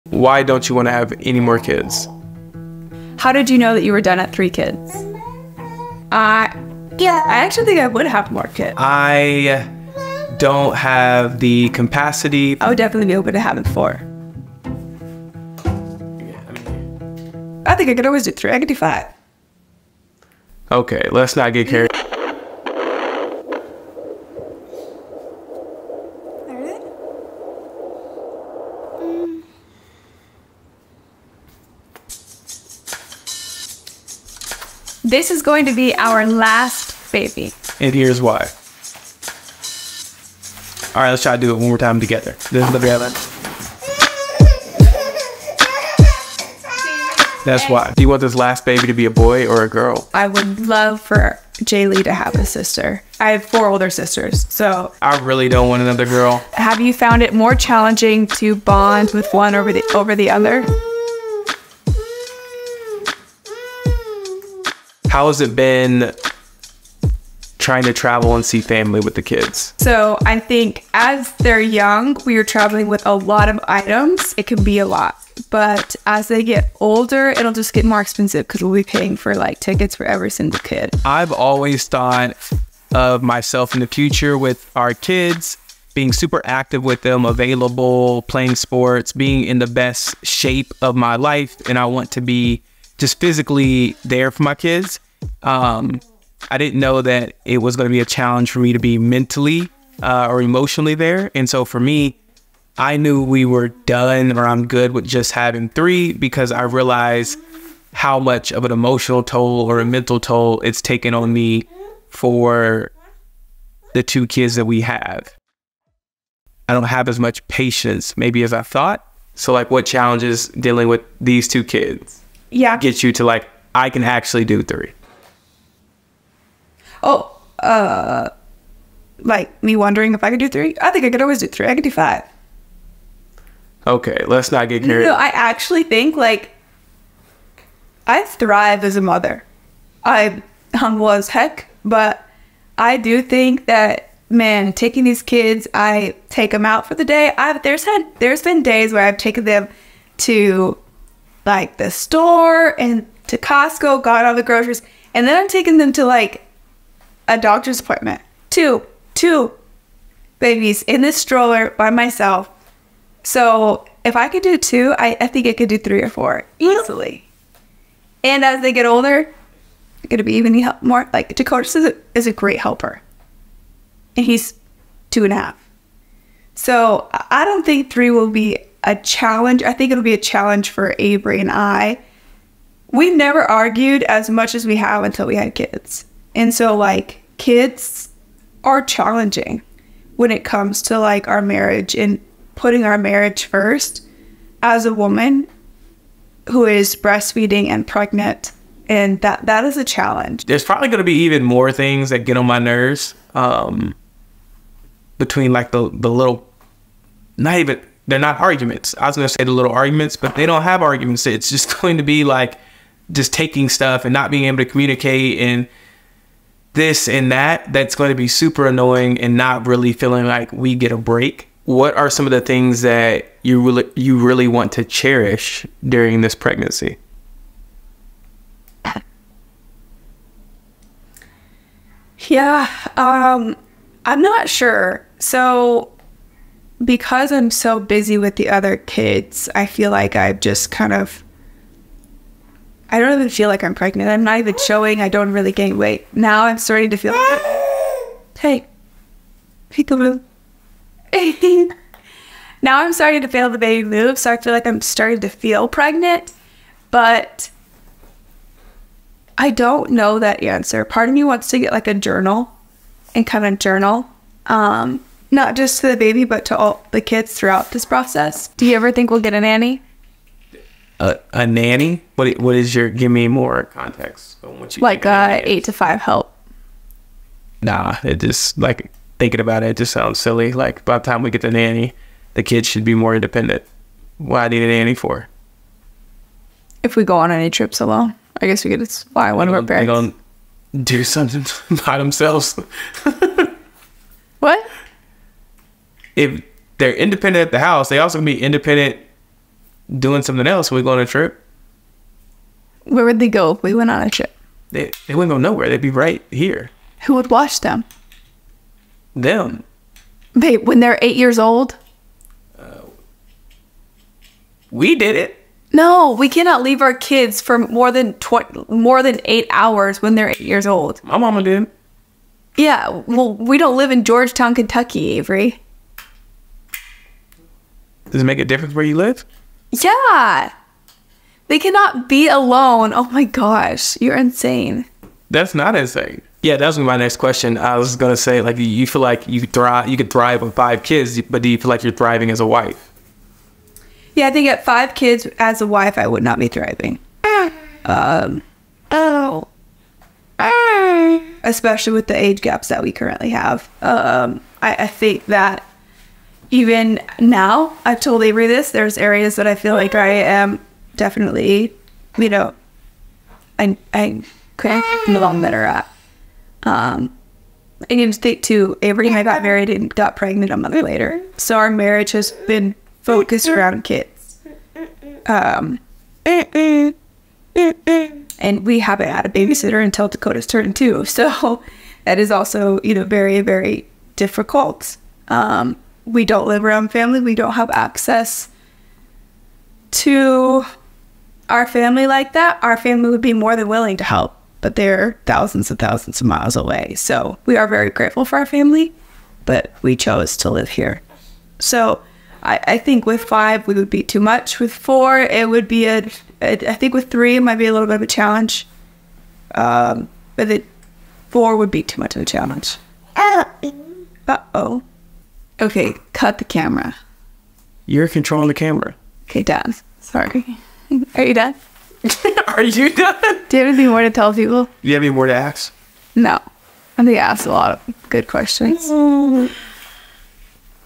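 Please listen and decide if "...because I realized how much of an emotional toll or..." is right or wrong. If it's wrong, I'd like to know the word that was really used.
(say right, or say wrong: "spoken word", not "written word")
right.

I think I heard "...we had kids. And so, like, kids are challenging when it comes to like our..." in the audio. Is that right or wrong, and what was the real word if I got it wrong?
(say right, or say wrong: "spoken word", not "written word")
right.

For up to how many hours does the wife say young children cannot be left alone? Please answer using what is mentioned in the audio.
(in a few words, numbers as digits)
8 hours.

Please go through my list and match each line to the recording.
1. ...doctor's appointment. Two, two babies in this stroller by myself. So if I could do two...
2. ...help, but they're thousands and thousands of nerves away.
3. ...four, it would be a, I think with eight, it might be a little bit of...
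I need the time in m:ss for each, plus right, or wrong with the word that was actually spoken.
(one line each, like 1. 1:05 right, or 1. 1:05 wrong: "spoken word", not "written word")
1. 2:37 right
2. 6:34 wrong: "miles", not "nerves"
3. 6:44 wrong: "three", not "eight".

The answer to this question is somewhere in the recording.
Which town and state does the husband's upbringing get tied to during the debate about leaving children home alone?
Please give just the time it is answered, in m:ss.
5:24.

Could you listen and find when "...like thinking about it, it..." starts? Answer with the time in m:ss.
4:38.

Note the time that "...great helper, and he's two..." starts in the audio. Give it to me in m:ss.
2:52.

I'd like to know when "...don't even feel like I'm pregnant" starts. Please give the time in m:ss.
4:02.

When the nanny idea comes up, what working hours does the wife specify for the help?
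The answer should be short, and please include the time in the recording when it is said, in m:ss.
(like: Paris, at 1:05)
8 to 5, at 4:35.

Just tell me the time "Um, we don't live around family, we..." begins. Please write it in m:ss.
6:25.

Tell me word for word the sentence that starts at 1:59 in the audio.
So, like, what challenges dealing with these two kids?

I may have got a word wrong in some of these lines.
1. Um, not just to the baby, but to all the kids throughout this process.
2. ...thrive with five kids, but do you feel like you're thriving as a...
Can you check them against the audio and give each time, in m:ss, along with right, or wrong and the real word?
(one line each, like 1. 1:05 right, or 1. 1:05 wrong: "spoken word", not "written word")
1. 4:24 right
2. 5:40 right.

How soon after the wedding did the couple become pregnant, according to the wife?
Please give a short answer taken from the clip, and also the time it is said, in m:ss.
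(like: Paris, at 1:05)
A month later, at 6:10.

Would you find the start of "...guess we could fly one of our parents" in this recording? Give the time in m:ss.
4:48.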